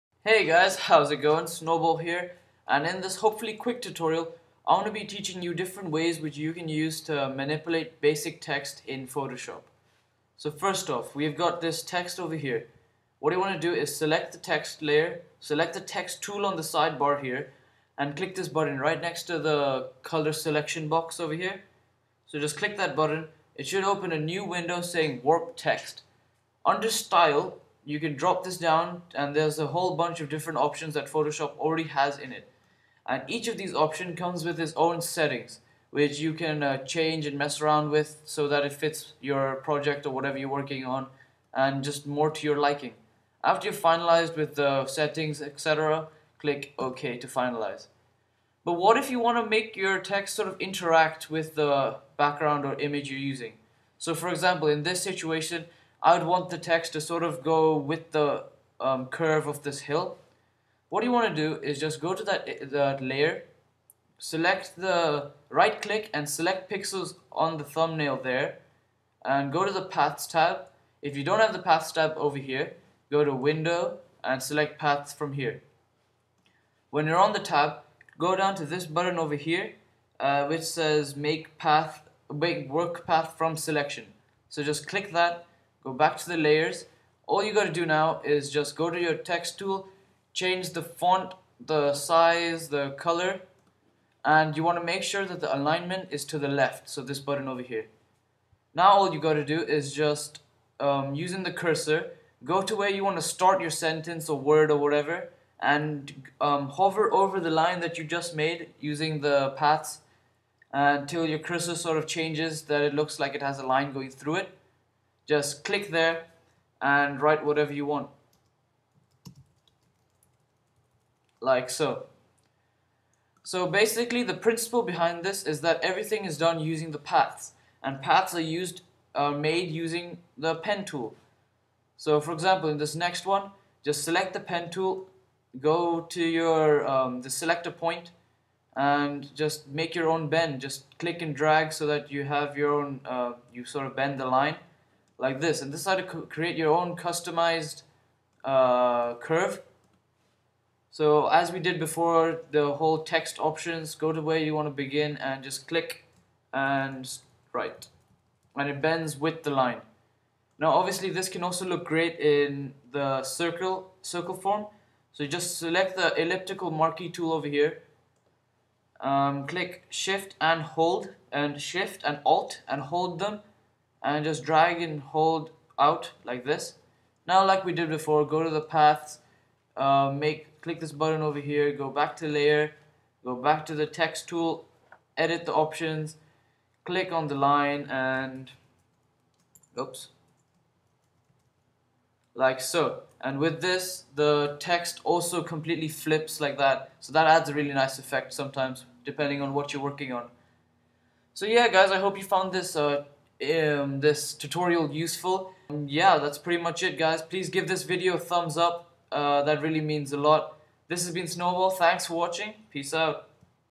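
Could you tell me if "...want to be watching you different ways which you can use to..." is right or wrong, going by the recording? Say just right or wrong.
wrong.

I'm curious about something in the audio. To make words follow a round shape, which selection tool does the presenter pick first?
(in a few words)
Elliptical marquee tool.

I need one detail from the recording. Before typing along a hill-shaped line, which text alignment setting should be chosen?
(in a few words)
Left.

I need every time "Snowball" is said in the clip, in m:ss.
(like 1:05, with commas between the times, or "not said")
0:01, 3:31.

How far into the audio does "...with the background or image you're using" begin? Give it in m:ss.
0:51.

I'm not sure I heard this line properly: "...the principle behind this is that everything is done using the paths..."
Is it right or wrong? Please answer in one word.
right.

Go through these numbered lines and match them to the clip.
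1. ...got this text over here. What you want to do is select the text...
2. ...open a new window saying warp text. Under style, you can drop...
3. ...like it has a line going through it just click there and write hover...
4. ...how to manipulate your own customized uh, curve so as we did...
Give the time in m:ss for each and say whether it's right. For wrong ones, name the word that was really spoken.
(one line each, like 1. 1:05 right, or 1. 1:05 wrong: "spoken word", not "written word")
1. 0:11 right
2. 0:23 right
3. 1:53 wrong: "whatever", not "hover"
4. 2:25 wrong: "create", not "manipulate".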